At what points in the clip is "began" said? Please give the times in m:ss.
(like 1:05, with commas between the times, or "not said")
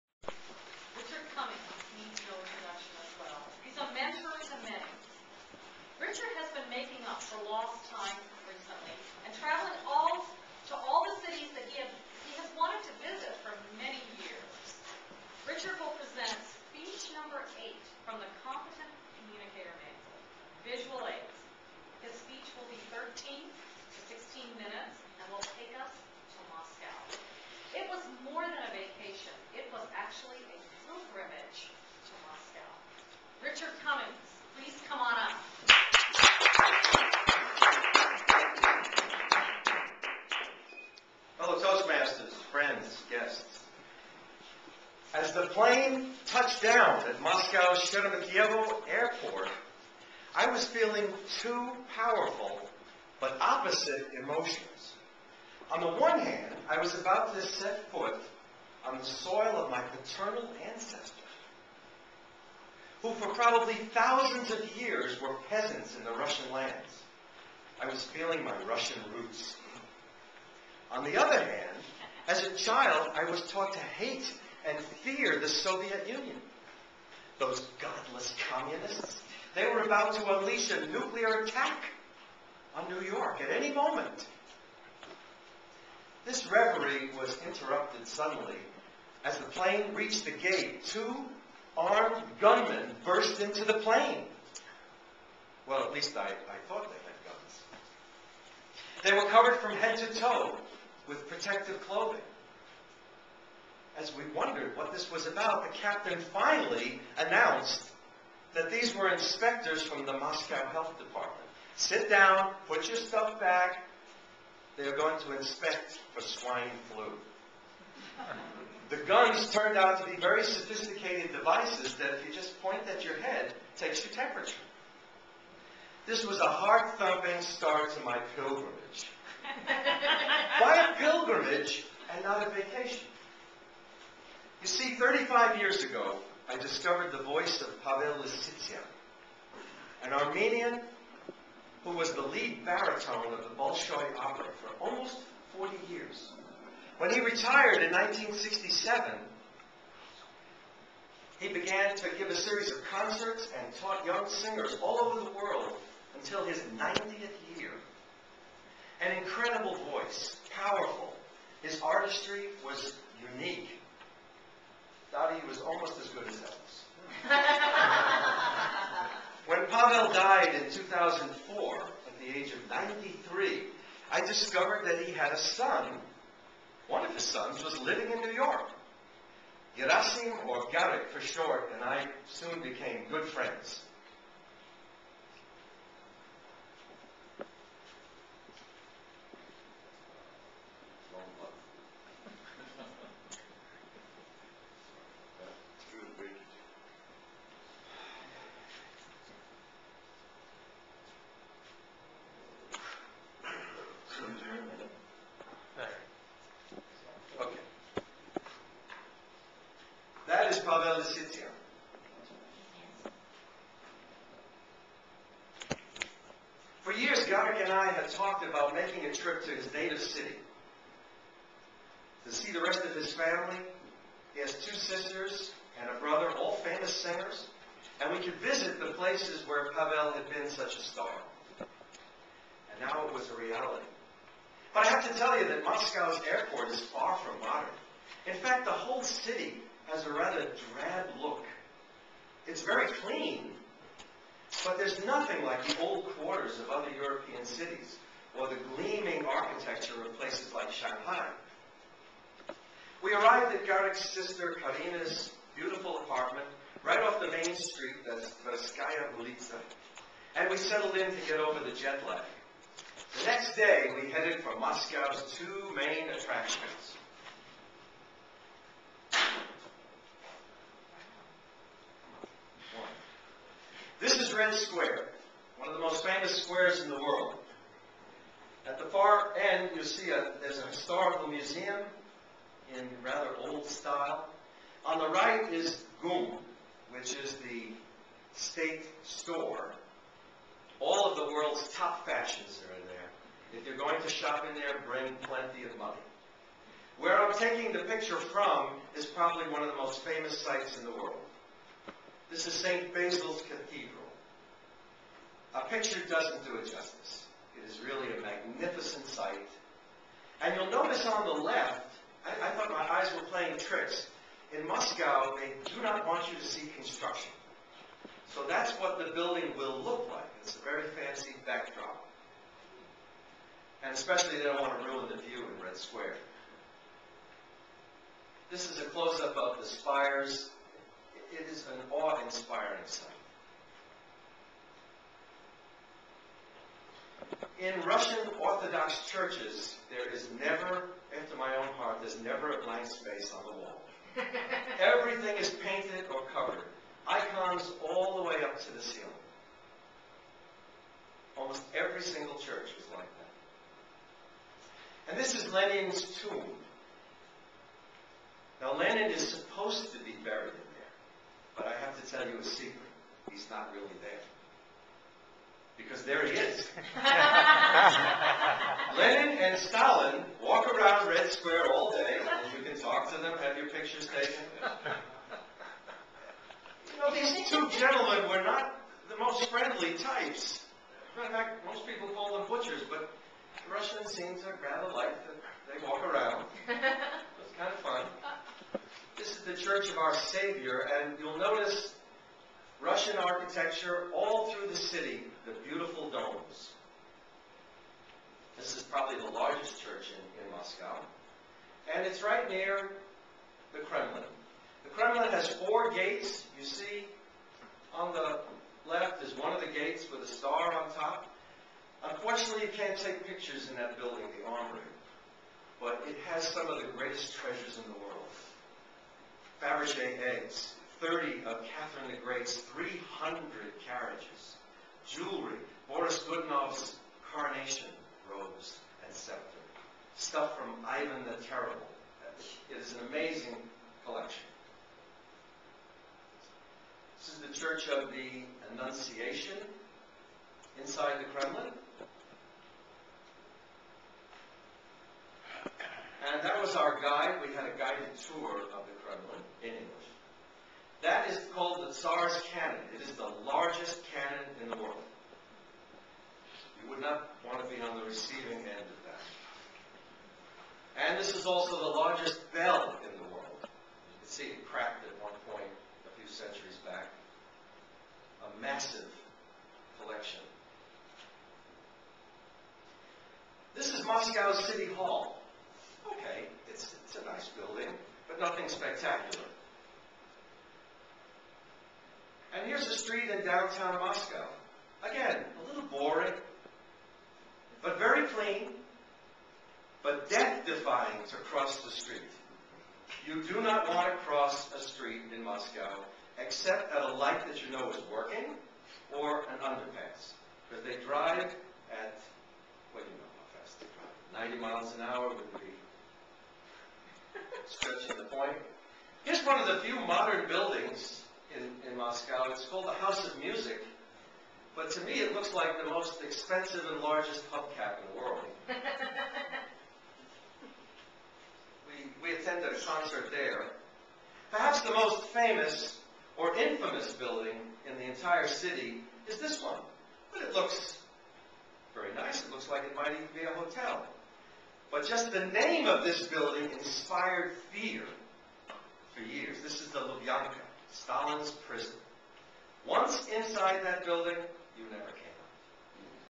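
2:31.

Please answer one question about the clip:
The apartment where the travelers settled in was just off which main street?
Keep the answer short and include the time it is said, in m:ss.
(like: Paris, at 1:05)
Tverskaya Ulitsa, at 4:18.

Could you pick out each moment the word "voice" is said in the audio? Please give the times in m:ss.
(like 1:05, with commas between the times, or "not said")
2:17, 2:39.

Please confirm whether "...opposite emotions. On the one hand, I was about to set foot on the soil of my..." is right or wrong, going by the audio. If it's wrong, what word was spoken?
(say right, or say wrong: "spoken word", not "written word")
right.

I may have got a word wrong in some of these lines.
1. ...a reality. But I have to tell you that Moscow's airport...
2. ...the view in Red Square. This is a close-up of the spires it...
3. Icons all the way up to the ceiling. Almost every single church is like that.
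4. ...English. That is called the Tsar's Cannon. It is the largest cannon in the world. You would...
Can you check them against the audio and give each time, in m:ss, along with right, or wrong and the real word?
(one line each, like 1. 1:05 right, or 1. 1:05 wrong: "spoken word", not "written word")
1. 3:53 right
2. 5:25 right
3. 5:47 right
4. 7:29 right.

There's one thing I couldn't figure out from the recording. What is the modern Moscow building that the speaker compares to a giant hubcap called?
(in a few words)
House of Music.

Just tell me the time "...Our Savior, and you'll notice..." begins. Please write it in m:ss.
6:29.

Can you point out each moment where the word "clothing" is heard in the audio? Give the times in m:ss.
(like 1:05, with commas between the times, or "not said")
1:41.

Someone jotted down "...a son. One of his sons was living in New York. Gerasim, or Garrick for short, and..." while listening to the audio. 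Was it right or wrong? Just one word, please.
right.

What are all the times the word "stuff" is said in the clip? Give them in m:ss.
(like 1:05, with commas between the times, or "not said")
1:52, 7:10.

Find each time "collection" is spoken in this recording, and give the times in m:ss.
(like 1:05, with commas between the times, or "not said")
7:14, 7:49.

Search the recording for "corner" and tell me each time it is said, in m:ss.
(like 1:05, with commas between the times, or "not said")
not said.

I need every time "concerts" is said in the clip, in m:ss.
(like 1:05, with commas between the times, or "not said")
2:32, 8:42.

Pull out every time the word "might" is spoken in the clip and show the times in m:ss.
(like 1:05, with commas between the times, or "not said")
8:52.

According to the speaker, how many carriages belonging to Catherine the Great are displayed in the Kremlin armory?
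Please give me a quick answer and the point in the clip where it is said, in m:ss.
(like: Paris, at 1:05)
30, at 7:01.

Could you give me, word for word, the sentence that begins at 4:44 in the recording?
On the right is GUM, which is the state store.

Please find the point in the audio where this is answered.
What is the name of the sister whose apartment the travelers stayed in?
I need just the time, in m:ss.
4:14.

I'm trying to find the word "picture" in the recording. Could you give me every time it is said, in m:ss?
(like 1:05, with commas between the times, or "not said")
4:57, 5:05, 6:13, 6:53.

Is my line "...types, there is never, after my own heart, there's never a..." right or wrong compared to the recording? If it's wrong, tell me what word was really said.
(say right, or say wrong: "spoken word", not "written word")
wrong: "churches", not "types".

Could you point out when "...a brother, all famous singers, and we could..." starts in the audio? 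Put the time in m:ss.
3:45.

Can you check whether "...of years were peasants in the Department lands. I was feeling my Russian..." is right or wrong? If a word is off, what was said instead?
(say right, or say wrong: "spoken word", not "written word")
wrong: "Russian", not "Department".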